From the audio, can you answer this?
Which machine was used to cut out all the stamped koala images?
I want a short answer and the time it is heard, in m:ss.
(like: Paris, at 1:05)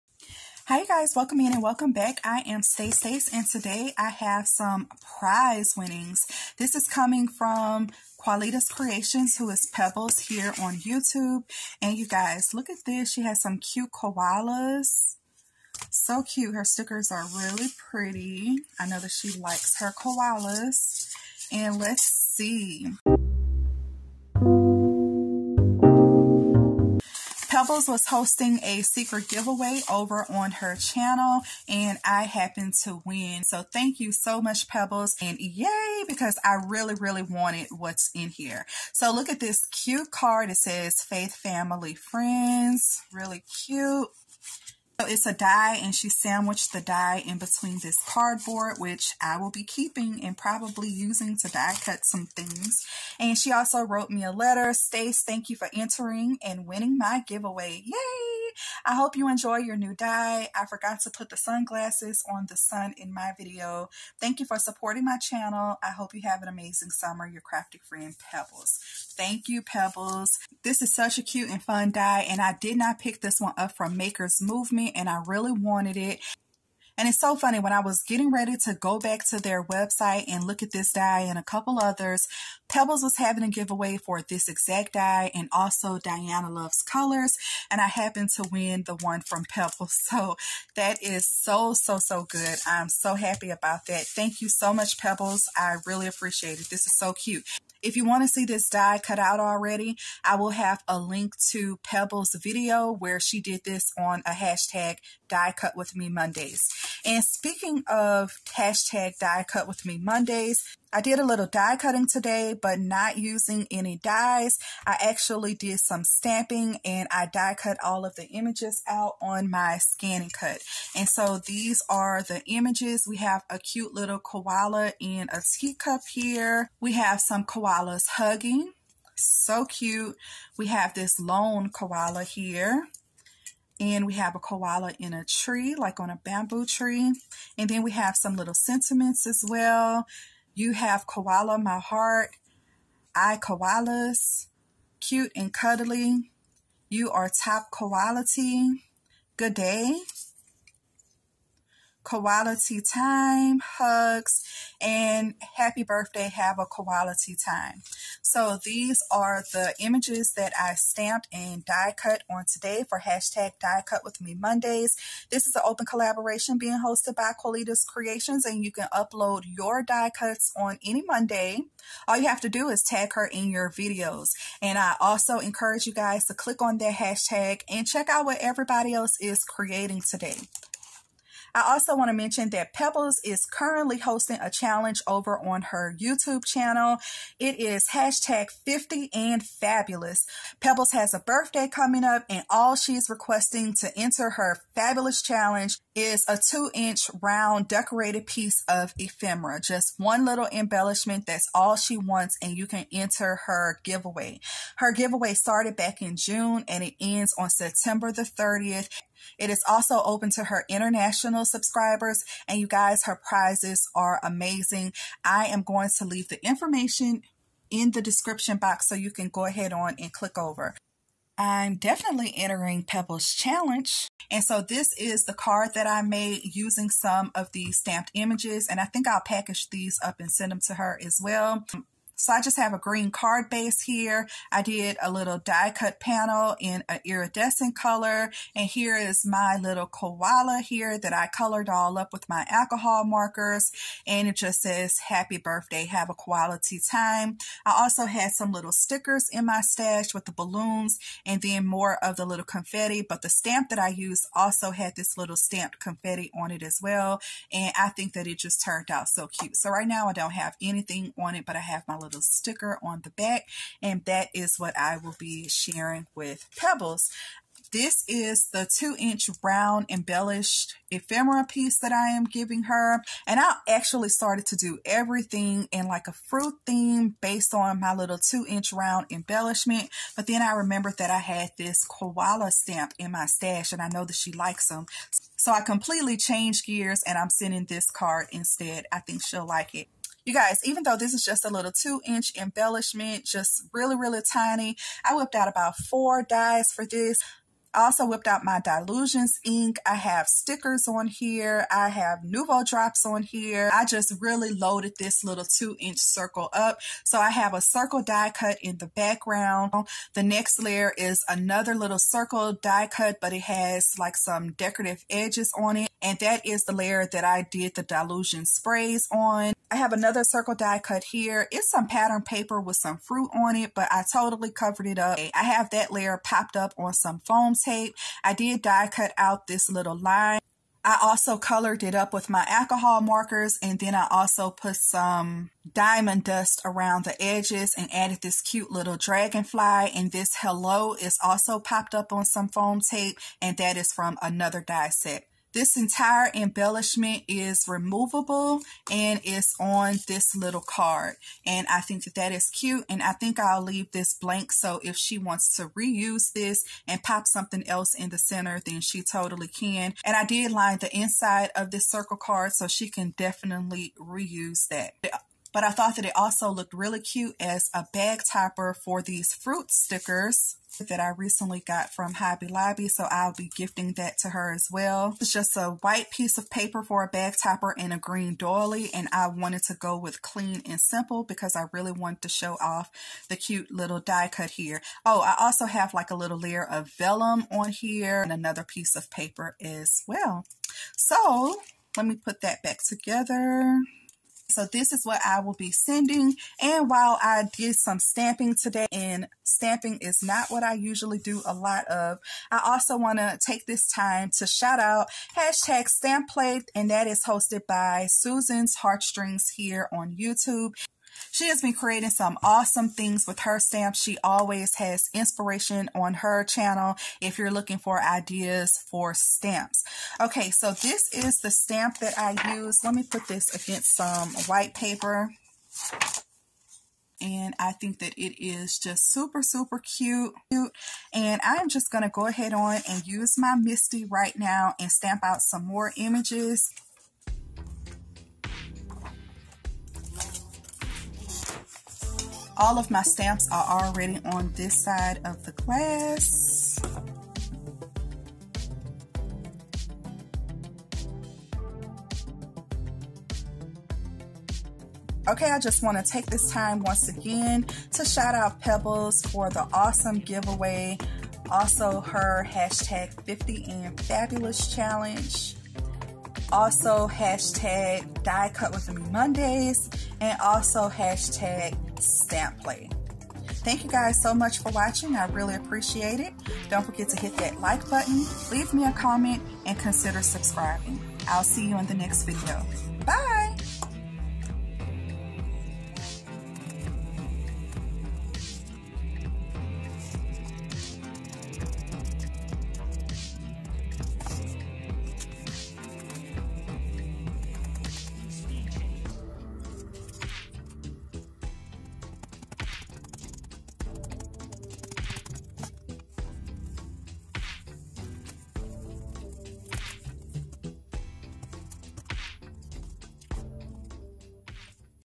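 ScanNCut, at 1:59.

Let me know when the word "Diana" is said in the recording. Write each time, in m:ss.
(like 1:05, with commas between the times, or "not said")
1:25.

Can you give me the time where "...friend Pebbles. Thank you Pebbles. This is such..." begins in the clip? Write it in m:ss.
1:07.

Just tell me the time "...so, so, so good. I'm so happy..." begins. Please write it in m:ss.
1:31.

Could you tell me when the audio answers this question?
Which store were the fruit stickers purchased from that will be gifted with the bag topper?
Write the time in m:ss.
6:12.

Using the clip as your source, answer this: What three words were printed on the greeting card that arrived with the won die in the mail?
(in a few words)
Faith Family Friends.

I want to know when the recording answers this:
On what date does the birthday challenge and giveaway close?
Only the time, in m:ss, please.
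3:27.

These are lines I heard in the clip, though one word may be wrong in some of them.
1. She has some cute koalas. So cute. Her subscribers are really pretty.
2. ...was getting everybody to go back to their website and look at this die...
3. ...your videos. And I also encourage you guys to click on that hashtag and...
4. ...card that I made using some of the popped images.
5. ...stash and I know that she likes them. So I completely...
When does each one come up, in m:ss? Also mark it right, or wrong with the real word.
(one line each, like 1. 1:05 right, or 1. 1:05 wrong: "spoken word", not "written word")
1. 0:13 wrong: "stickers", not "subscribers"
2. 1:17 wrong: "ready", not "everybody"
3. 2:53 right
4. 3:45 wrong: "stamped", not "popped"
5. 4:43 right.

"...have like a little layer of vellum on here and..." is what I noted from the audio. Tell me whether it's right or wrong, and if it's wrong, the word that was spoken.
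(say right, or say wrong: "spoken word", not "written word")
right.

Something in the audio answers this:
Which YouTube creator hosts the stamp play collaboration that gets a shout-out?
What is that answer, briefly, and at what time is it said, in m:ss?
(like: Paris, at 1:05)
Susan's Heartstrings, at 6:48.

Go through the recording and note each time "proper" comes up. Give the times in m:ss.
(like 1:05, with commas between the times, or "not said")
not said.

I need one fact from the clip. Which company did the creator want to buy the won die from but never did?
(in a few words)
Maker's Movement.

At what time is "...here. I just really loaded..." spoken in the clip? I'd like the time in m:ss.
5:03.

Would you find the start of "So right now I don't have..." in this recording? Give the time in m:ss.
4:19.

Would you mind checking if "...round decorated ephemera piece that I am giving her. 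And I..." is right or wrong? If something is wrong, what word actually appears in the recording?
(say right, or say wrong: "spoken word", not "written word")
wrong: "embellished", not "decorated".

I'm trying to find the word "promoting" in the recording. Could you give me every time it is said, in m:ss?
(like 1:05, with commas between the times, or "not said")
not said.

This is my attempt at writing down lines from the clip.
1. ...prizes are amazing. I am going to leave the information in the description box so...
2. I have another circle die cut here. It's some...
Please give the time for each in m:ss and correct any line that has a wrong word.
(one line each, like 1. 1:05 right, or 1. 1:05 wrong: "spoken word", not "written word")
1. 3:33 right
2. 5:19 right.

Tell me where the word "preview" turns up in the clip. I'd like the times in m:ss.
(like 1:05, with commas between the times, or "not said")
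not said.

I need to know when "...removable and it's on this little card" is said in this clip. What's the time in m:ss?
5:47.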